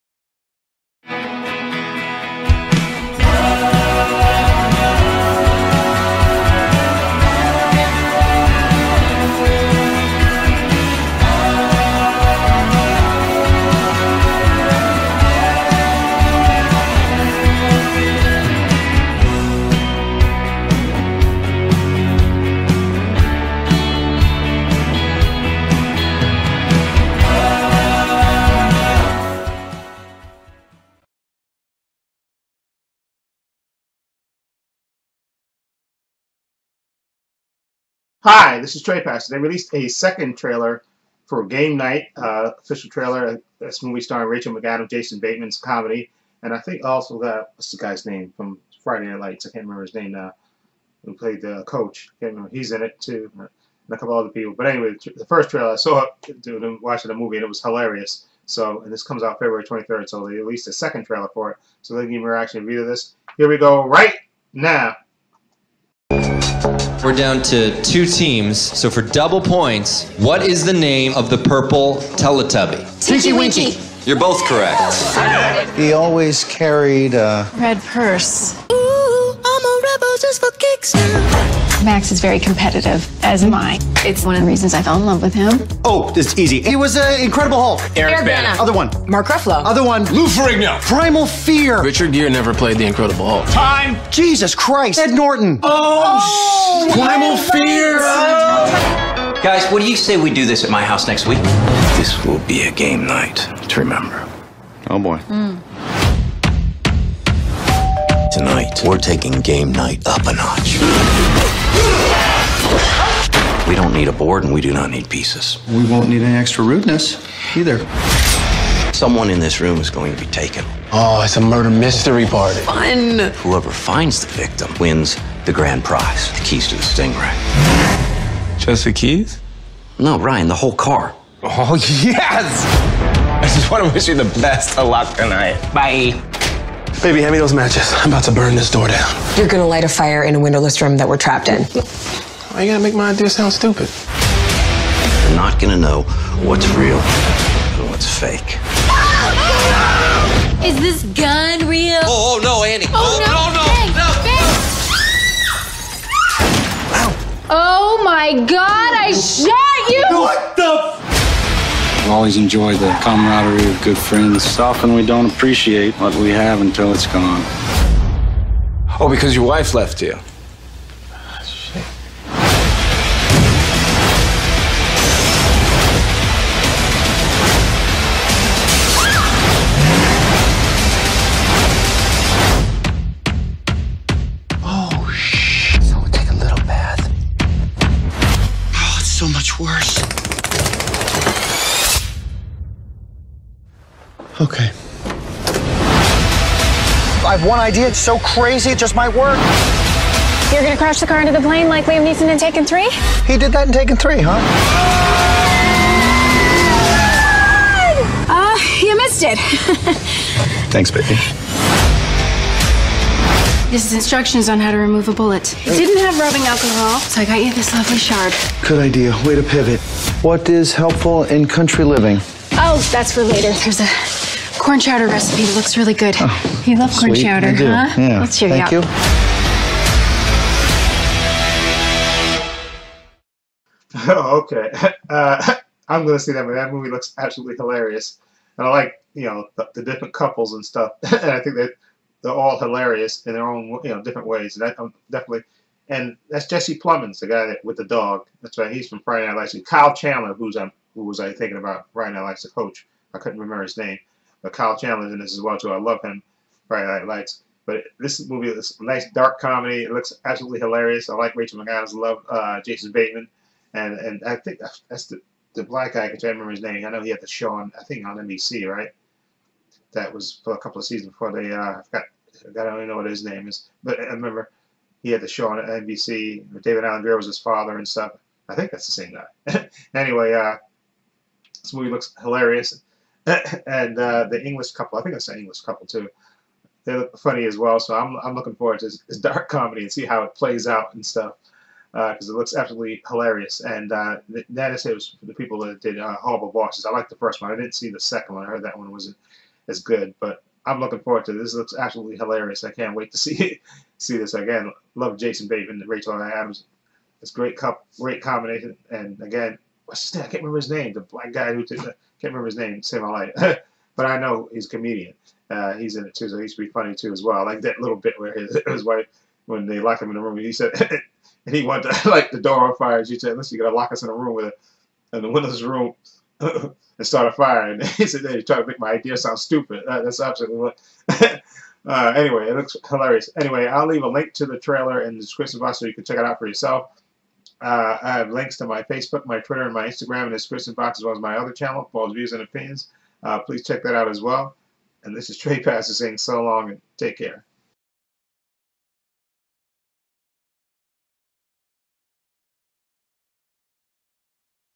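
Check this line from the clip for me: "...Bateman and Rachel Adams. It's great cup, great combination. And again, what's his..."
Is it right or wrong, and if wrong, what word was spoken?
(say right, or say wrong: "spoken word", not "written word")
right.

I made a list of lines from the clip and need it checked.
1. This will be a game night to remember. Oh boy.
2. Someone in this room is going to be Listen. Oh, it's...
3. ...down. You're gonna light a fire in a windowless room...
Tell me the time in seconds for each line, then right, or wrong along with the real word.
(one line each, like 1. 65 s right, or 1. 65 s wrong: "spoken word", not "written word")
1. 101 s right
2. 118 s wrong: "taken", not "Listen"
3. 138 s right.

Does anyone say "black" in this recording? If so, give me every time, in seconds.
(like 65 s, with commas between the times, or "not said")
265 s, 311 s.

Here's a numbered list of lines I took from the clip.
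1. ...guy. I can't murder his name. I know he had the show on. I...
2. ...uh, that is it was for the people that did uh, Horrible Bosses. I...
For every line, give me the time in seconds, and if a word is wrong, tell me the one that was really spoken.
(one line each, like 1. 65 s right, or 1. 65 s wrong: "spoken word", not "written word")
1. 265 s wrong: "remember", not "murder"
2. 293 s right.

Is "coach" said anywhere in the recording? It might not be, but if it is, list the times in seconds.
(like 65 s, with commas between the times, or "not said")
51 s, 252 s.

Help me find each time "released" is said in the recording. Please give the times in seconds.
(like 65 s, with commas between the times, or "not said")
39 s, 60 s.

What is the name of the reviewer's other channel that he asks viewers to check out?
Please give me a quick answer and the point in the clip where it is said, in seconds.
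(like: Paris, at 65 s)
Paul's Views and Opinions, at 341 s.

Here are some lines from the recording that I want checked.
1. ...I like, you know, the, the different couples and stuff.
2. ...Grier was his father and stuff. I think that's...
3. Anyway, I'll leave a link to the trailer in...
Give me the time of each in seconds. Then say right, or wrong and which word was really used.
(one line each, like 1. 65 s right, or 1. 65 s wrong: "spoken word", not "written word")
1. 238 s right
2. 277 s right
3. 333 s right.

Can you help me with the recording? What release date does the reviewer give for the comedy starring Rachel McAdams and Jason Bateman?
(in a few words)
February 23rd.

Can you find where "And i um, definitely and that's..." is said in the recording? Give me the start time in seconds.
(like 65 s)
244 s.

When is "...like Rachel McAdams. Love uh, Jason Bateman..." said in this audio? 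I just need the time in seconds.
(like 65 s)
261 s.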